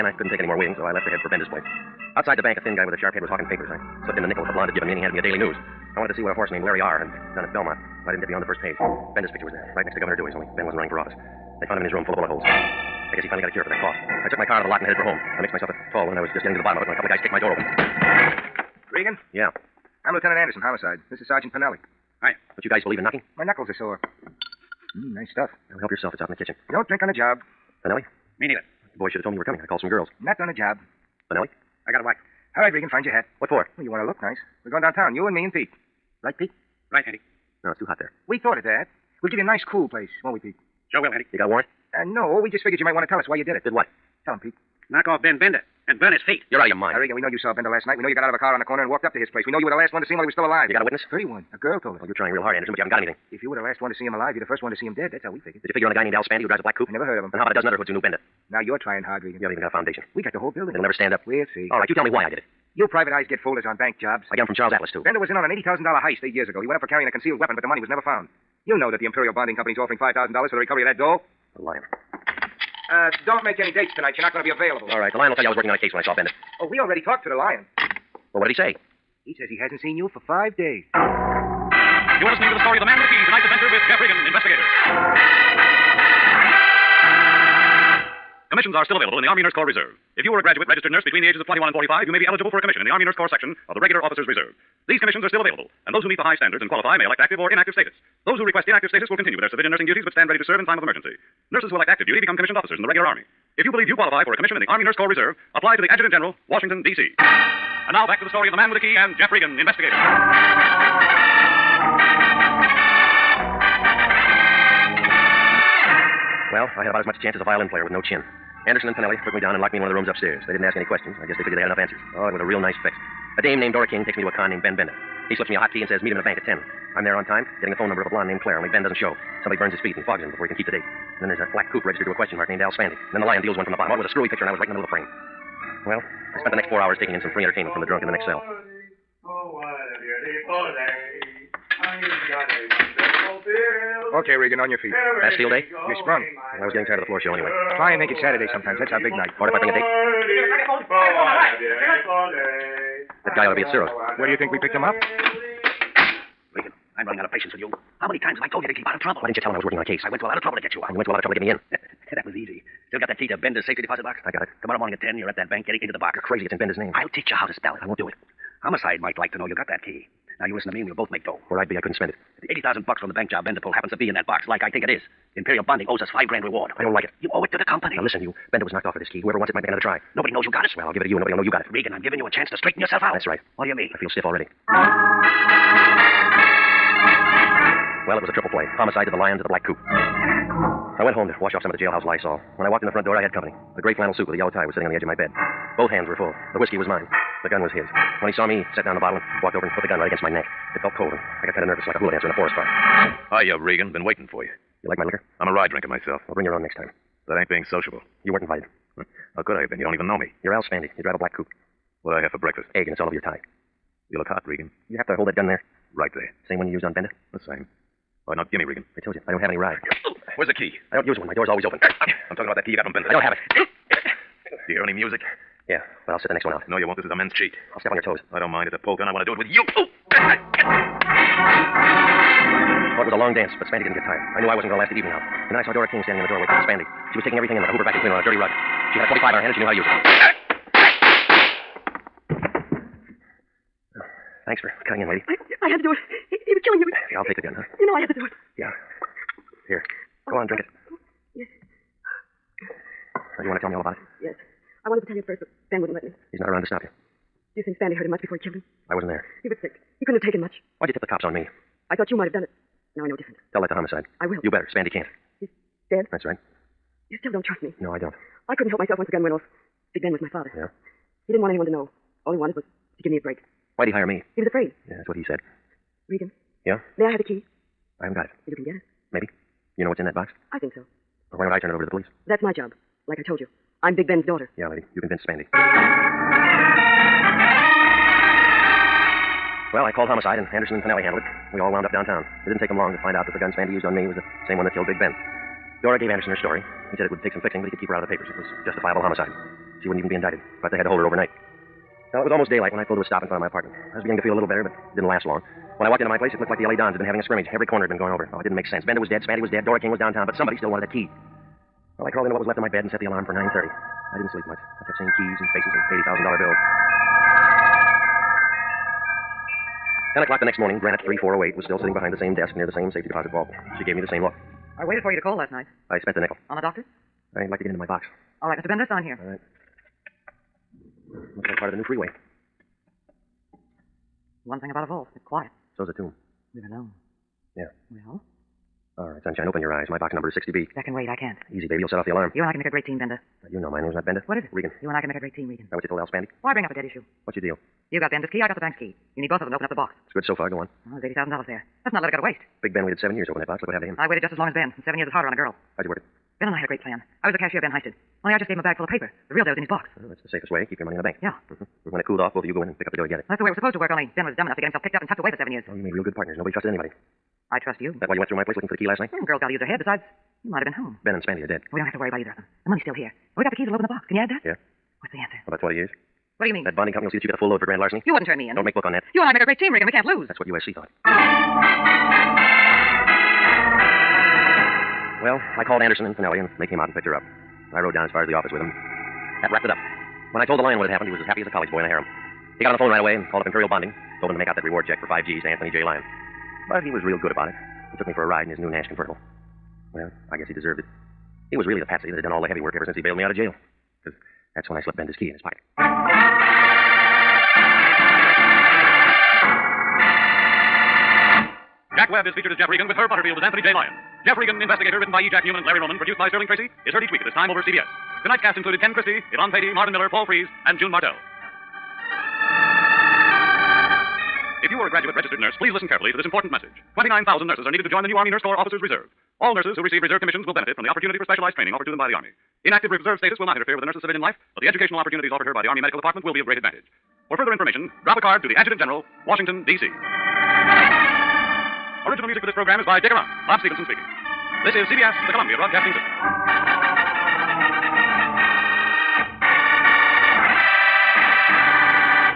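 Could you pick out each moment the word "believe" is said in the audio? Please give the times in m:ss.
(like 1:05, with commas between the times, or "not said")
0:22, 1:43.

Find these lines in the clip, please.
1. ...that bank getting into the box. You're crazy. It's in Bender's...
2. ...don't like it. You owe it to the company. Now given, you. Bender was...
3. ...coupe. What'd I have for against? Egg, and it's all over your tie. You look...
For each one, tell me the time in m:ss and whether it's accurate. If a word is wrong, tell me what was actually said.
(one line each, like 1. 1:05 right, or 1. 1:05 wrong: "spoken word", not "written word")
1. 2:45 right
2. 2:56 wrong: "listen", not "given"
3. 3:31 wrong: "breakfast", not "against".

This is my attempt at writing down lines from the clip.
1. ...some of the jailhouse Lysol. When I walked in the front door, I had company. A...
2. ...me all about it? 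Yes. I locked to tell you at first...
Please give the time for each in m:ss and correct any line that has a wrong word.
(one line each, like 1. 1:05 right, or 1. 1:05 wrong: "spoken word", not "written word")
1. 3:11 right
2. 4:13 wrong: "wanted", not "locked".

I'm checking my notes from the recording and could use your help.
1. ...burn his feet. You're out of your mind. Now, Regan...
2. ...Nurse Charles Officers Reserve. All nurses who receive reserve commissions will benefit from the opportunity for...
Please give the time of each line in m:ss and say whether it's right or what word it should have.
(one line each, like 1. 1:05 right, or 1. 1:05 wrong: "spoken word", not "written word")
1. 0:46 right
2. 7:08 wrong: "Corps", not "Charles".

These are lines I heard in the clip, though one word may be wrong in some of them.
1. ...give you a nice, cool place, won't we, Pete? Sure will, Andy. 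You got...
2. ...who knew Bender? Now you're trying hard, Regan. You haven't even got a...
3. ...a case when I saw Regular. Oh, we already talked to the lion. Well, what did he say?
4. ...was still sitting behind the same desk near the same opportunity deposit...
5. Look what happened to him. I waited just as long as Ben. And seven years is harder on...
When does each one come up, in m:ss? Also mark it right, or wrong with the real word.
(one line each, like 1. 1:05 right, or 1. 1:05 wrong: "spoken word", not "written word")
1. 0:39 right
2. 0:57 right
3. 1:15 wrong: "Bender", not "Regular"
4. 5:21 wrong: "safety", not "opportunity"
5. 5:53 right.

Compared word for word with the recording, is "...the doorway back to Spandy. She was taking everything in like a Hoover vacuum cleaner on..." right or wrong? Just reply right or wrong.
right.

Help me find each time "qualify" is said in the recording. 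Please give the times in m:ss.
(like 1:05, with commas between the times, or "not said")
1:36, 1:43.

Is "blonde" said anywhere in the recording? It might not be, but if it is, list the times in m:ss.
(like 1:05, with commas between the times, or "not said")
0:04, 2:08.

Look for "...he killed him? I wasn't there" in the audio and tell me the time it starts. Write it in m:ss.
4:18.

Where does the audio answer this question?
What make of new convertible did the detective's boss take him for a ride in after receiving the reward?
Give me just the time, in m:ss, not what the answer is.
6:38.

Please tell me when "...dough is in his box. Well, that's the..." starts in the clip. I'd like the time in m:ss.
5:59.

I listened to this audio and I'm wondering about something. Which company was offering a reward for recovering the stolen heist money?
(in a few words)
Imperial Bonding Company.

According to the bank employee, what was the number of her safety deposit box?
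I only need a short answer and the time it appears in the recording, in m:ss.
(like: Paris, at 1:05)
60B, at 5:40.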